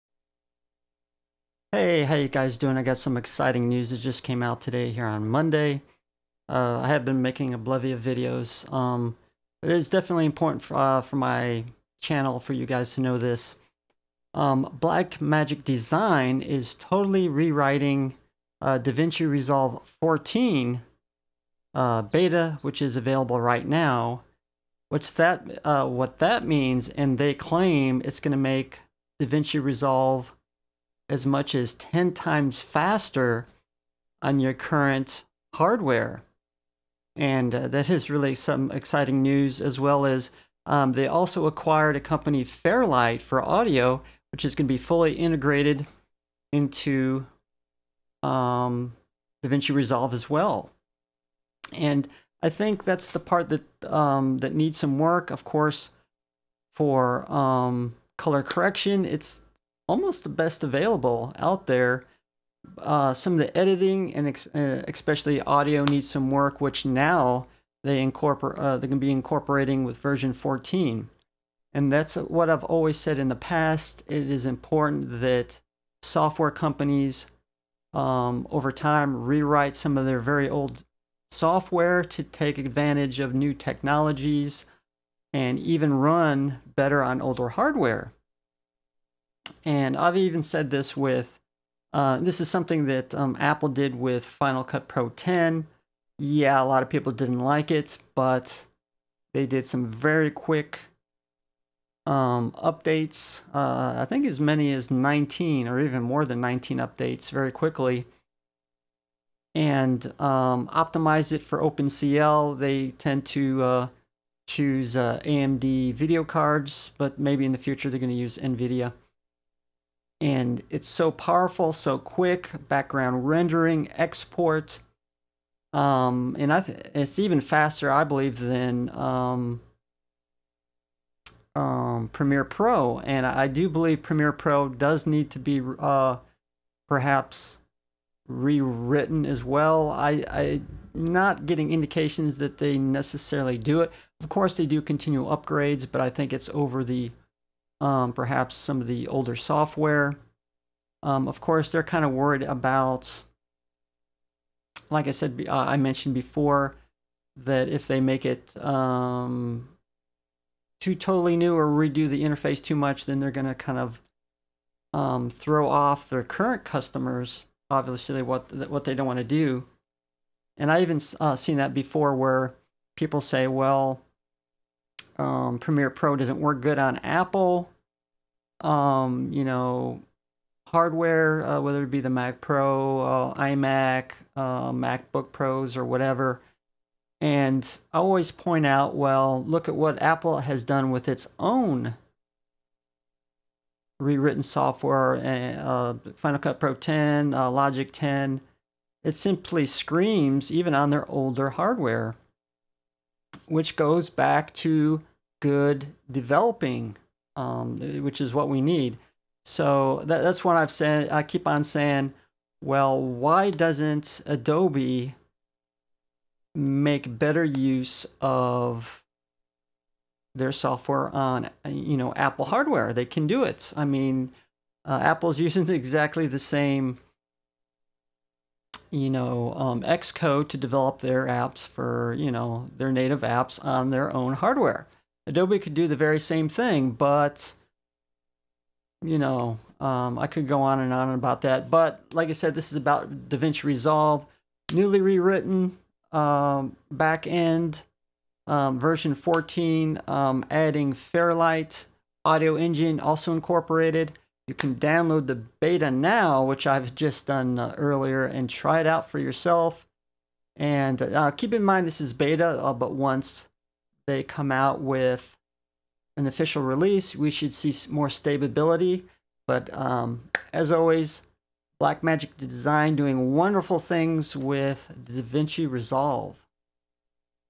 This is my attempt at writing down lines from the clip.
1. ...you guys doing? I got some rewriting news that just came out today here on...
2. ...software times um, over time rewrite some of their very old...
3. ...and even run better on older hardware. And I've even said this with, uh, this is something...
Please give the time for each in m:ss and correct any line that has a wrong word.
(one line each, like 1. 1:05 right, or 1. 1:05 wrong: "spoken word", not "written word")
1. 0:02 wrong: "exciting", not "rewriting"
2. 1:16 wrong: "companies", not "times"
3. 1:25 right.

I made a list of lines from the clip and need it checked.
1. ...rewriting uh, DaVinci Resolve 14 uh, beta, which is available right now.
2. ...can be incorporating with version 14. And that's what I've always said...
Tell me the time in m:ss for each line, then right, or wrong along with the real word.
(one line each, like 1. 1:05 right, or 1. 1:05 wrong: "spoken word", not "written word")
1. 0:17 right
2. 1:08 right.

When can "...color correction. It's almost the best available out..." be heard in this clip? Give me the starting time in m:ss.
0:58.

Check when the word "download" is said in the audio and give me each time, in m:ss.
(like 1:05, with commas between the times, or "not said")
4:14.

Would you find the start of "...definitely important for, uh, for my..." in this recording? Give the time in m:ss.
0:09.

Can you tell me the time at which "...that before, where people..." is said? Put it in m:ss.
2:51.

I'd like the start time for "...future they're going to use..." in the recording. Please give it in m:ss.
1:57.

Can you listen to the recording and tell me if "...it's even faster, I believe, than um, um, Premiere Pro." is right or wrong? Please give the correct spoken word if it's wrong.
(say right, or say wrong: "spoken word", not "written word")
right.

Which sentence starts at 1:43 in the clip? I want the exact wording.
Uh, I think as many as 19 or even more than 19 updates very quickly and um, optimize it for OpenCL.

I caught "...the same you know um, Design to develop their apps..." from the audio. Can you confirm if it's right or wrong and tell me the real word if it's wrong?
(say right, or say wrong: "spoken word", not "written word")
wrong: "Xcode", not "Design".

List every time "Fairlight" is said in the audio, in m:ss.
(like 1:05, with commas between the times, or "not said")
0:42, 4:10.